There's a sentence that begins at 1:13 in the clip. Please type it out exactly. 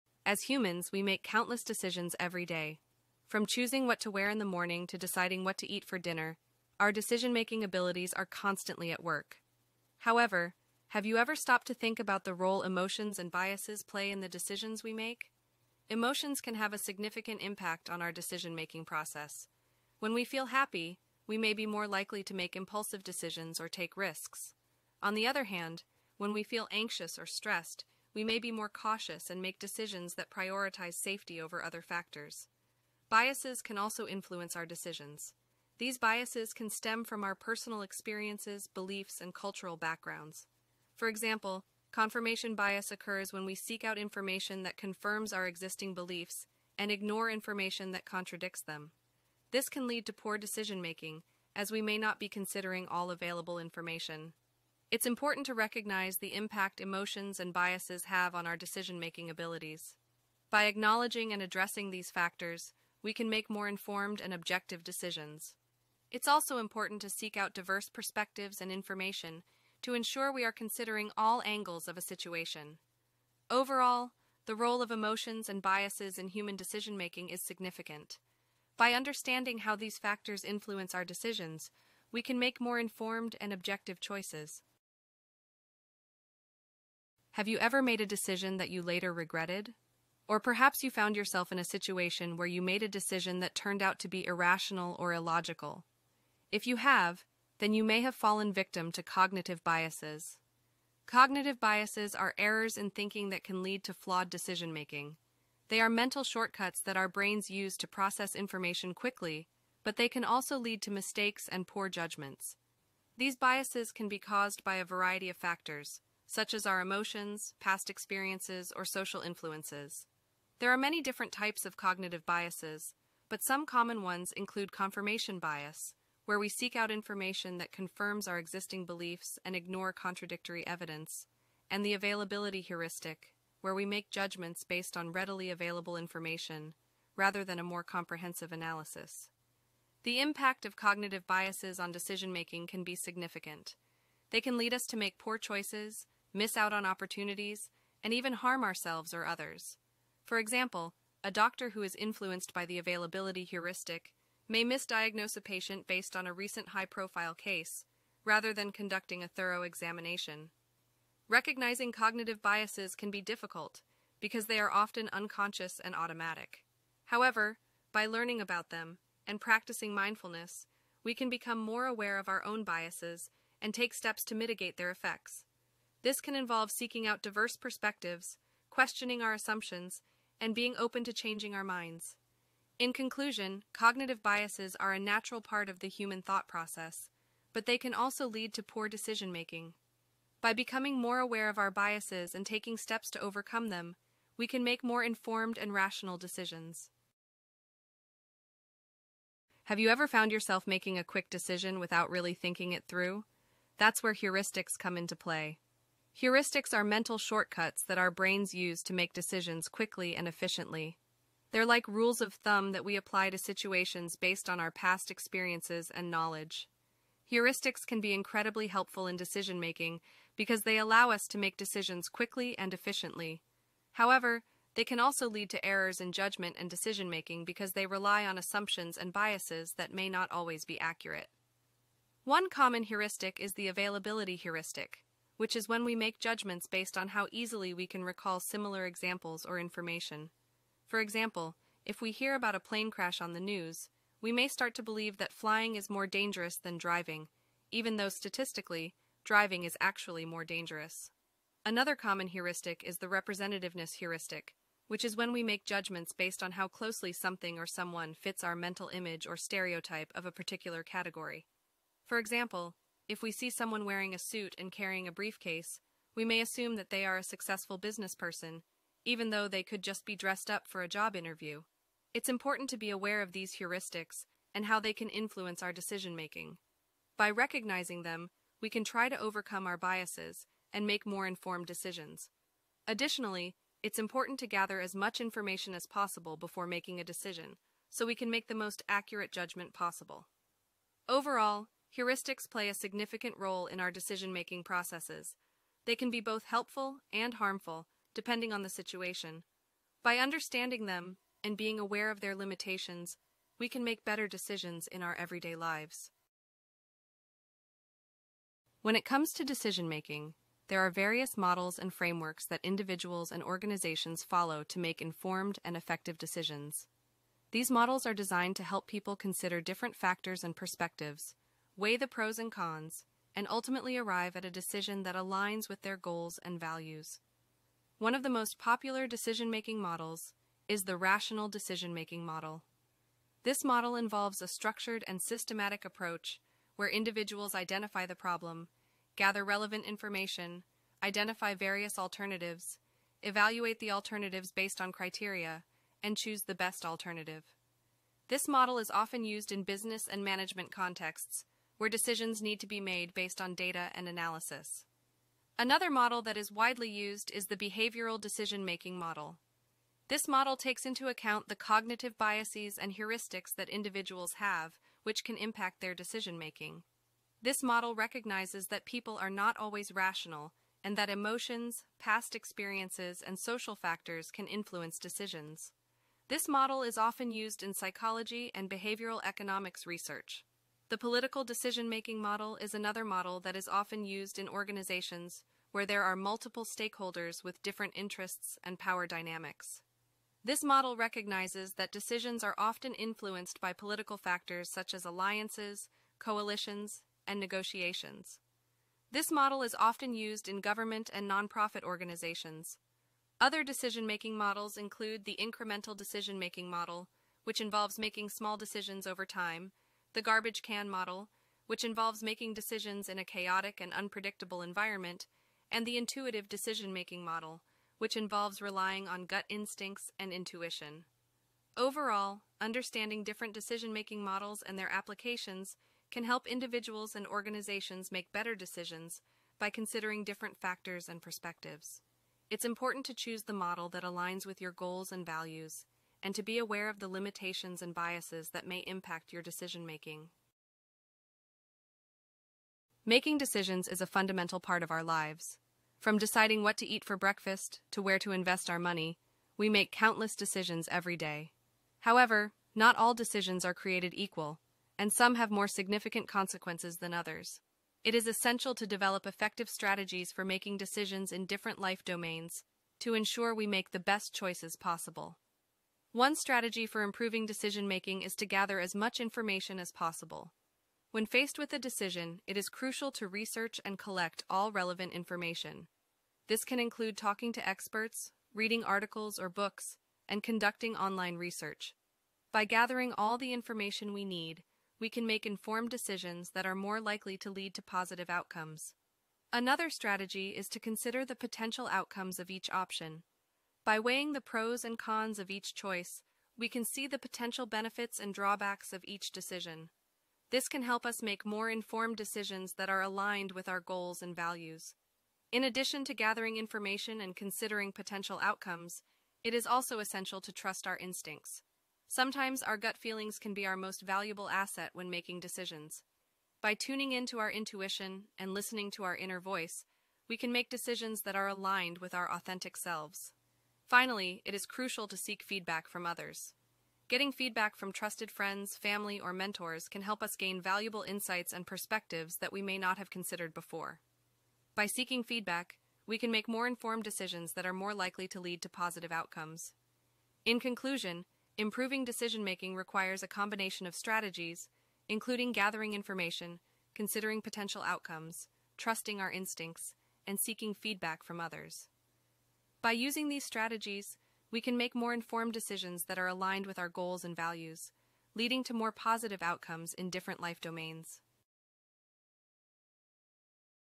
Overall, the role of emotions and biases in human decision-making is significant.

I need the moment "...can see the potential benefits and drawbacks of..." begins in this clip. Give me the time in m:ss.
8:16.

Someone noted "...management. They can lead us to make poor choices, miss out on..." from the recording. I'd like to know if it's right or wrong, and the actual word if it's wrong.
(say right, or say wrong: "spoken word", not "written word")
wrong: "significant", not "management".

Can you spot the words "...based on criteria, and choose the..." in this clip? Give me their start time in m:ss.
5:44.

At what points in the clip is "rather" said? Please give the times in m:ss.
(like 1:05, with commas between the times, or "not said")
2:17, 2:38.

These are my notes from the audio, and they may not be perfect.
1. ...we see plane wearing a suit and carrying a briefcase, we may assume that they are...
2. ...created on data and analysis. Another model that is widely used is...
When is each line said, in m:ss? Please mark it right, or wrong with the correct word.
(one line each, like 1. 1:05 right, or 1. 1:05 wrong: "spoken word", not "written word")
1. 4:23 wrong: "someone", not "plane"
2. 5:53 wrong: "based", not "created".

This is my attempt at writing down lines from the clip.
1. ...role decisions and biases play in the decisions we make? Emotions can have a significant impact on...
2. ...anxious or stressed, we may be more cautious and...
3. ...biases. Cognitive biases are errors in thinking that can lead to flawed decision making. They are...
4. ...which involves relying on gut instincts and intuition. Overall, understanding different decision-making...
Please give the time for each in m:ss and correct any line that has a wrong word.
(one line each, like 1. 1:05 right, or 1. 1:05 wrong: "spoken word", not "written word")
1. 0:12 wrong: "emotions", not "decisions"
2. 0:26 right
3. 1:39 right
4. 6:57 right.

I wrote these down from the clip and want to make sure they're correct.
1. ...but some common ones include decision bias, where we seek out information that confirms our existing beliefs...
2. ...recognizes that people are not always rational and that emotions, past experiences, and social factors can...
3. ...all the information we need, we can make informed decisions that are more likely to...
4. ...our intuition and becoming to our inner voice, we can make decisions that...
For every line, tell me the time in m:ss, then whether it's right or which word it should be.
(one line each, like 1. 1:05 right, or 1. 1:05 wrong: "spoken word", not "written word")
1. 2:03 wrong: "confirmation", not "decision"
2. 6:07 right
3. 8:03 right
4. 8:37 wrong: "listening", not "becoming".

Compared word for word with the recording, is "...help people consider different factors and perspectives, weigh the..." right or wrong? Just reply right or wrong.
right.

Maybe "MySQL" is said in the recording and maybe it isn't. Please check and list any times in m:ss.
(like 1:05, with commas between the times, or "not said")
not said.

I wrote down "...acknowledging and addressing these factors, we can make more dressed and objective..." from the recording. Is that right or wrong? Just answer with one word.
wrong.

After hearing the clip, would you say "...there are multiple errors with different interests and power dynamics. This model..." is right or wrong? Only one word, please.
wrong.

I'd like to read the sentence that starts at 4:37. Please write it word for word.
By recognizing them, we can try to overcome our biases and make more informed decisions.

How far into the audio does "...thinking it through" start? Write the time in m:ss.
3:22.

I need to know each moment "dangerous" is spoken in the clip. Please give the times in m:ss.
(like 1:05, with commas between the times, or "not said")
4:06, 4:10.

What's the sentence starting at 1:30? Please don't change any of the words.
Or perhaps you found yourself in a situation where you made a decision that turned out to be irrational or illogical.